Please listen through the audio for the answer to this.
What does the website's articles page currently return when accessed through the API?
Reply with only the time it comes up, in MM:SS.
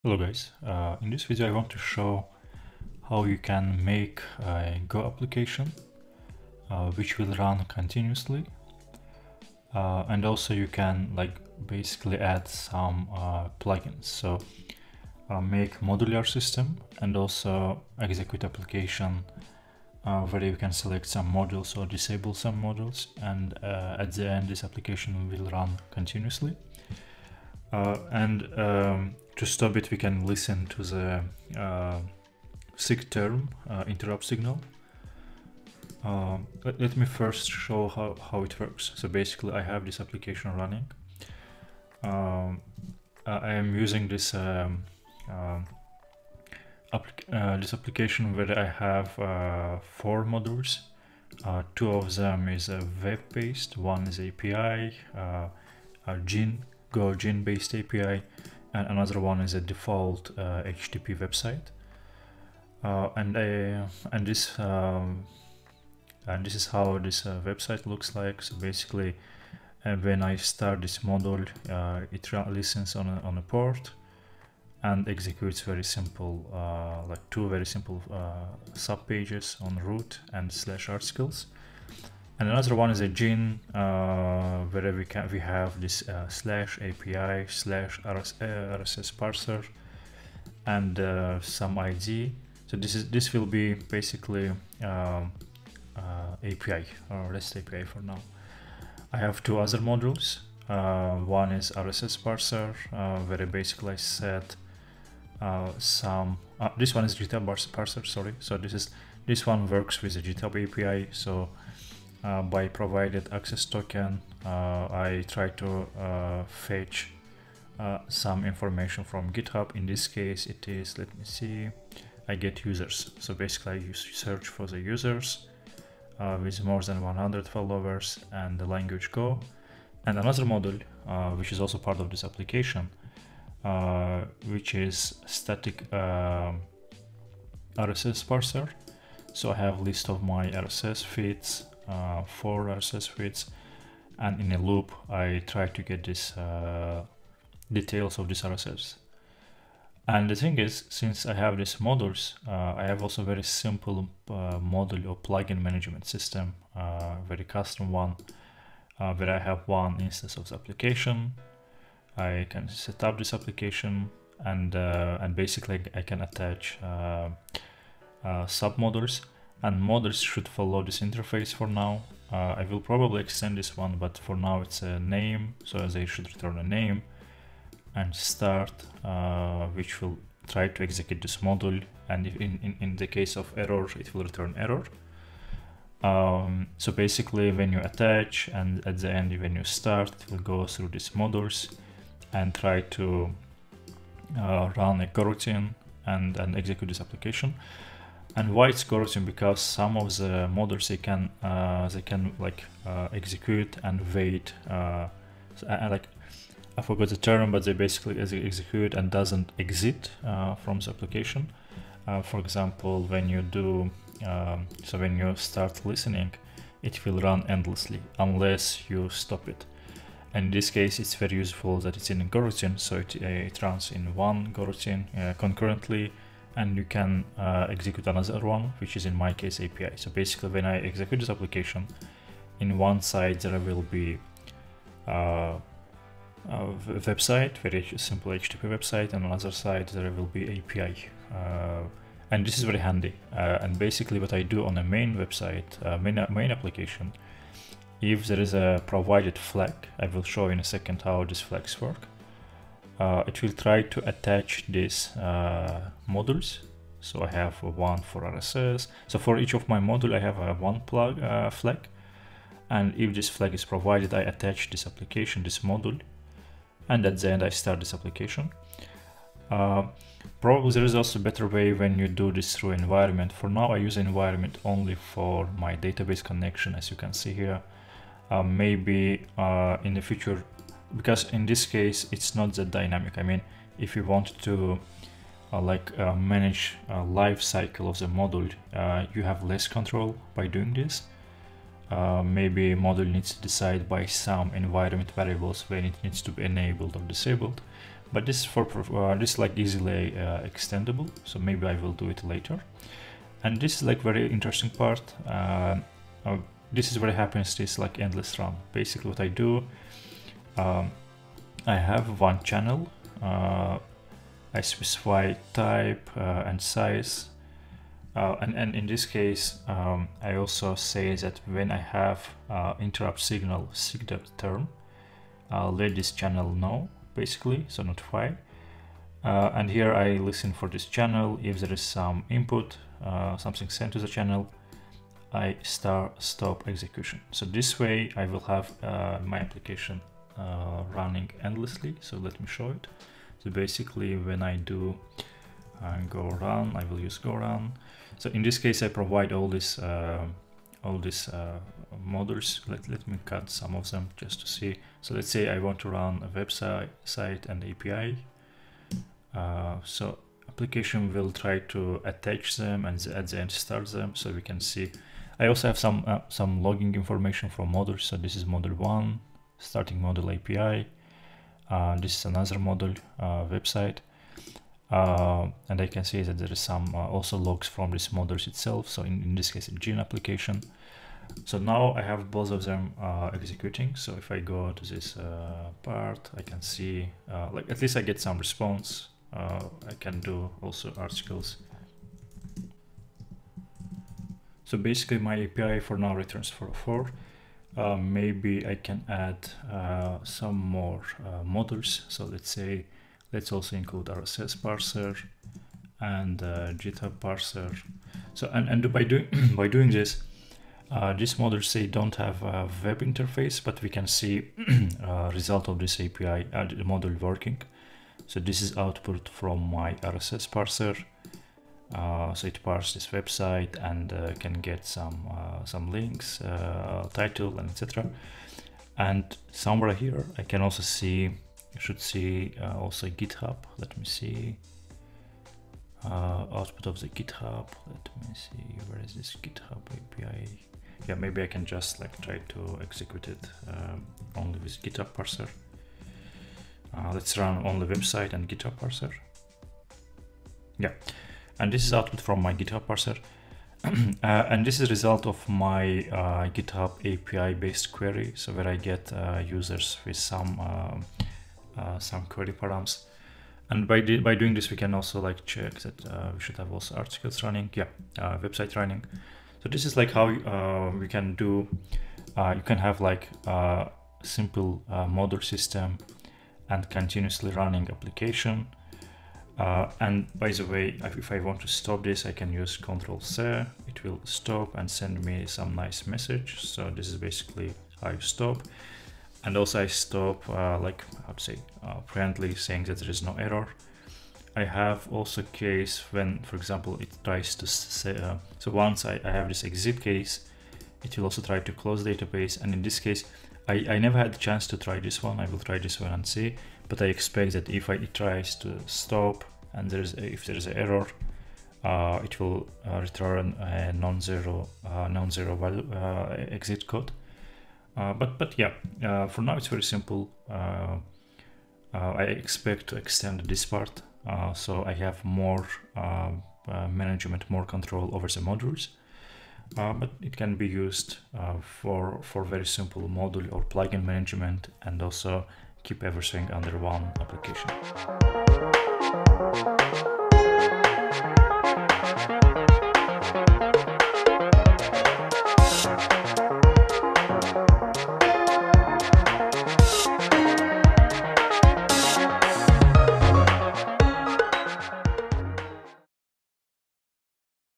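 06:36.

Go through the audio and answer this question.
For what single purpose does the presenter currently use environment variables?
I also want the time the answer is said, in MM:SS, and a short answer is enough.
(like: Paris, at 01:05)
database connection, at 04:35.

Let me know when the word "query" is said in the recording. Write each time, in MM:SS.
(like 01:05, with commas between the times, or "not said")
07:37, 07:42.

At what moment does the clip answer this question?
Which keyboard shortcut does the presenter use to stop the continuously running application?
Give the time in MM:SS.
08:02.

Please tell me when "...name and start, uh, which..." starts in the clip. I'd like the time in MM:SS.
02:56.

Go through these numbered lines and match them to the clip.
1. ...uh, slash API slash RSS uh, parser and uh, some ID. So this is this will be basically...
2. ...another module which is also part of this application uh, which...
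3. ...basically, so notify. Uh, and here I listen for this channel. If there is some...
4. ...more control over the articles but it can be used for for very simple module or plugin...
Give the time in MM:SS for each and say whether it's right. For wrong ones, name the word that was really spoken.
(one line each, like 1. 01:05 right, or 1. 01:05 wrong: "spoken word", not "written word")
1. 01:26 right
2. 02:10 right
3. 05:27 right
4. 08:47 wrong: "modules", not "articles".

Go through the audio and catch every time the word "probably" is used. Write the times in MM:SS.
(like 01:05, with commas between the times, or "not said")
02:52, 04:30.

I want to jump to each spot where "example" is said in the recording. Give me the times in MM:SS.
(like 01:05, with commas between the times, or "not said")
03:32, 08:16.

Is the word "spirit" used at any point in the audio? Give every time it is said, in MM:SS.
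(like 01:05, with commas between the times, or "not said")
not said.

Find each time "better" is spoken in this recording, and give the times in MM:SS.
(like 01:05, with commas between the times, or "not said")
04:31.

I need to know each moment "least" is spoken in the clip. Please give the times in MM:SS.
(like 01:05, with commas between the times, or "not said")
06:27.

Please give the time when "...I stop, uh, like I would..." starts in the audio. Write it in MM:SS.
08:09.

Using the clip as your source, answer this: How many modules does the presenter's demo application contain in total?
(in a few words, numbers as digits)
4.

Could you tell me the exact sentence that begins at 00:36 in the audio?
Um, let, let, me first show how, how it works.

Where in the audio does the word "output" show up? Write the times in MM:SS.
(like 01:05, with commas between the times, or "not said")
06:58, 07:16, 07:32.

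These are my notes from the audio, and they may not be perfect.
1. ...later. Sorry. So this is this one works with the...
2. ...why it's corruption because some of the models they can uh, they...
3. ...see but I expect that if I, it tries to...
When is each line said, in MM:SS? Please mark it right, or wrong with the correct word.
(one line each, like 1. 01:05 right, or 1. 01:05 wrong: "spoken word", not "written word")
1. 01:47 wrong: "parser", not "later"
2. 03:18 right
3. 08:26 right.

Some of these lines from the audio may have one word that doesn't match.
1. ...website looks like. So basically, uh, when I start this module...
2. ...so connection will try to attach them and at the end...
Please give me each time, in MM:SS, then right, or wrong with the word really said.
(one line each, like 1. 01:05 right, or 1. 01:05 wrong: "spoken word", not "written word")
1. 01:07 right
2. 05:59 wrong: "application", not "connection".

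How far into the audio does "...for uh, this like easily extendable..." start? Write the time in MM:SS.
04:58.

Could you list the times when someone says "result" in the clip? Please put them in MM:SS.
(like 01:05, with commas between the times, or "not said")
06:55, 07:34.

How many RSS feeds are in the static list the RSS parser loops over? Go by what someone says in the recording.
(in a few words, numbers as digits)
4.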